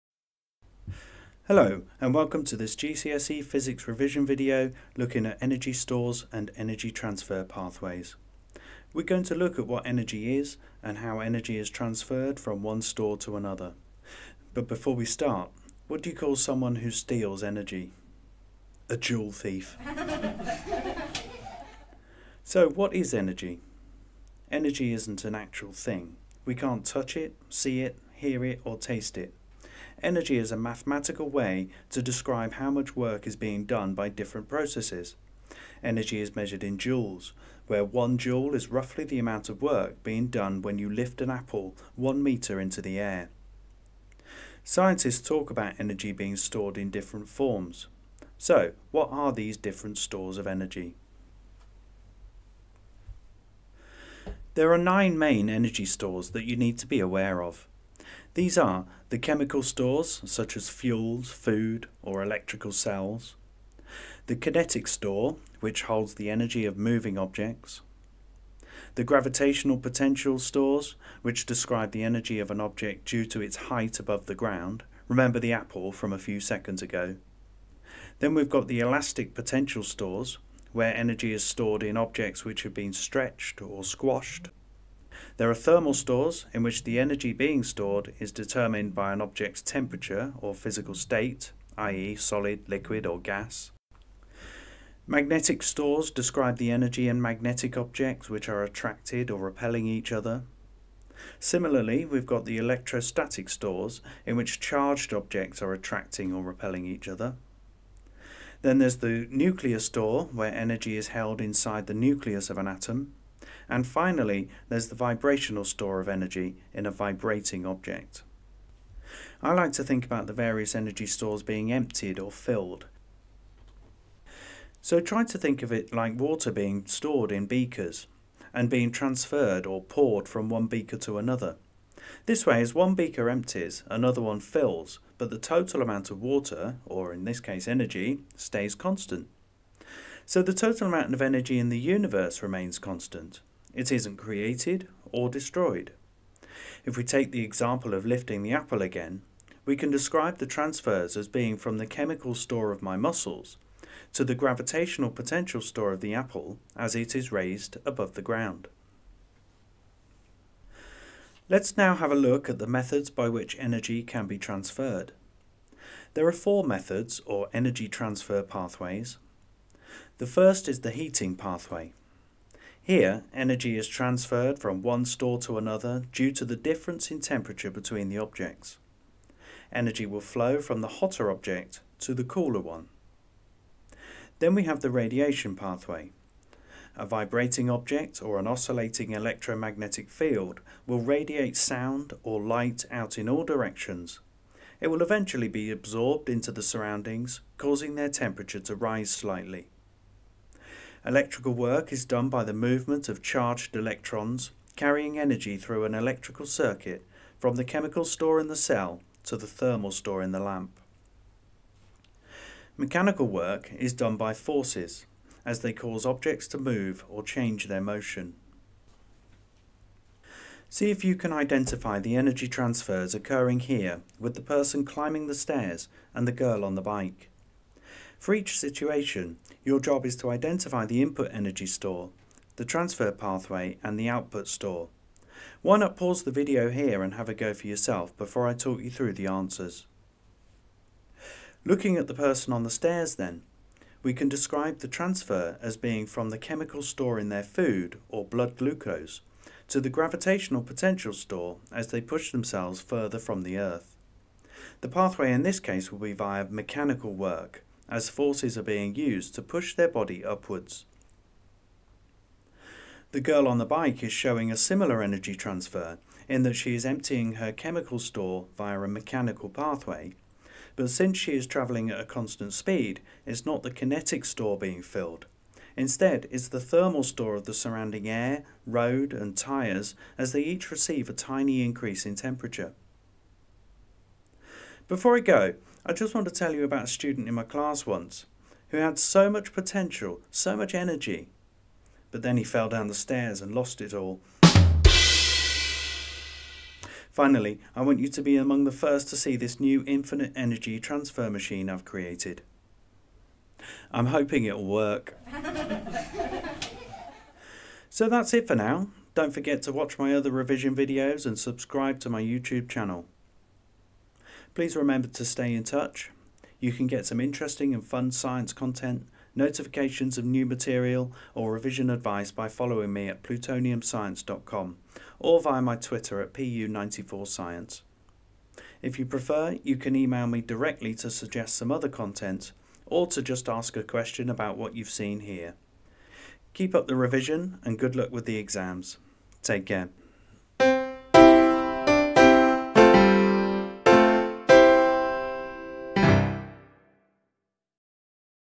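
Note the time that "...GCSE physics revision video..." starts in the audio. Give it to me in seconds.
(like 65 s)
2 s.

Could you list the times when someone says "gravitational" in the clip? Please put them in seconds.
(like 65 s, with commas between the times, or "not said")
69 s, 154 s, 249 s.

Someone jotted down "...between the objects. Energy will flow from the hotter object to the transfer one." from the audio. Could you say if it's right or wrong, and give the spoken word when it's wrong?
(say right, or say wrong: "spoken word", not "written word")
wrong: "cooler", not "transfer".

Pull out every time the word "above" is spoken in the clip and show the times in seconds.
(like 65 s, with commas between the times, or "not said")
73 s, 157 s.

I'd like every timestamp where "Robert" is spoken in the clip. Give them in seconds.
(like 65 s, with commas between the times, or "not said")
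not said.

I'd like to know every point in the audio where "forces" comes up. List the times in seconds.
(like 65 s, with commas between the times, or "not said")
214 s, 258 s.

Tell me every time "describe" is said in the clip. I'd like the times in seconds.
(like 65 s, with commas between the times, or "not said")
32 s, 71 s, 96 s, 149 s, 244 s.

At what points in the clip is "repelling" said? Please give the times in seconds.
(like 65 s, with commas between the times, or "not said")
99 s, 106 s.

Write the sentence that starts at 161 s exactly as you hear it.
Let's now have a look at the methods by which energy can be transferred.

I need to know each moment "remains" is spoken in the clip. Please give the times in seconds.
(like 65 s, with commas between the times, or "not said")
142 s.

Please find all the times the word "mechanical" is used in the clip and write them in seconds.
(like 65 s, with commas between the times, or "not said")
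212 s, 256 s, 268 s.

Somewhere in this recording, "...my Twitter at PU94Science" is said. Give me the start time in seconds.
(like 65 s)
325 s.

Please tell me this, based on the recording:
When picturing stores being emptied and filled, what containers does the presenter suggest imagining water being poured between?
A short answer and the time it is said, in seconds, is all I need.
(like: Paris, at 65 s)
beakers, at 127 s.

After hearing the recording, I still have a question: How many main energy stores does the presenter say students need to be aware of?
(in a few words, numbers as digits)
9.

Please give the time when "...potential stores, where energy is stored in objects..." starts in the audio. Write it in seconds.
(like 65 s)
79 s.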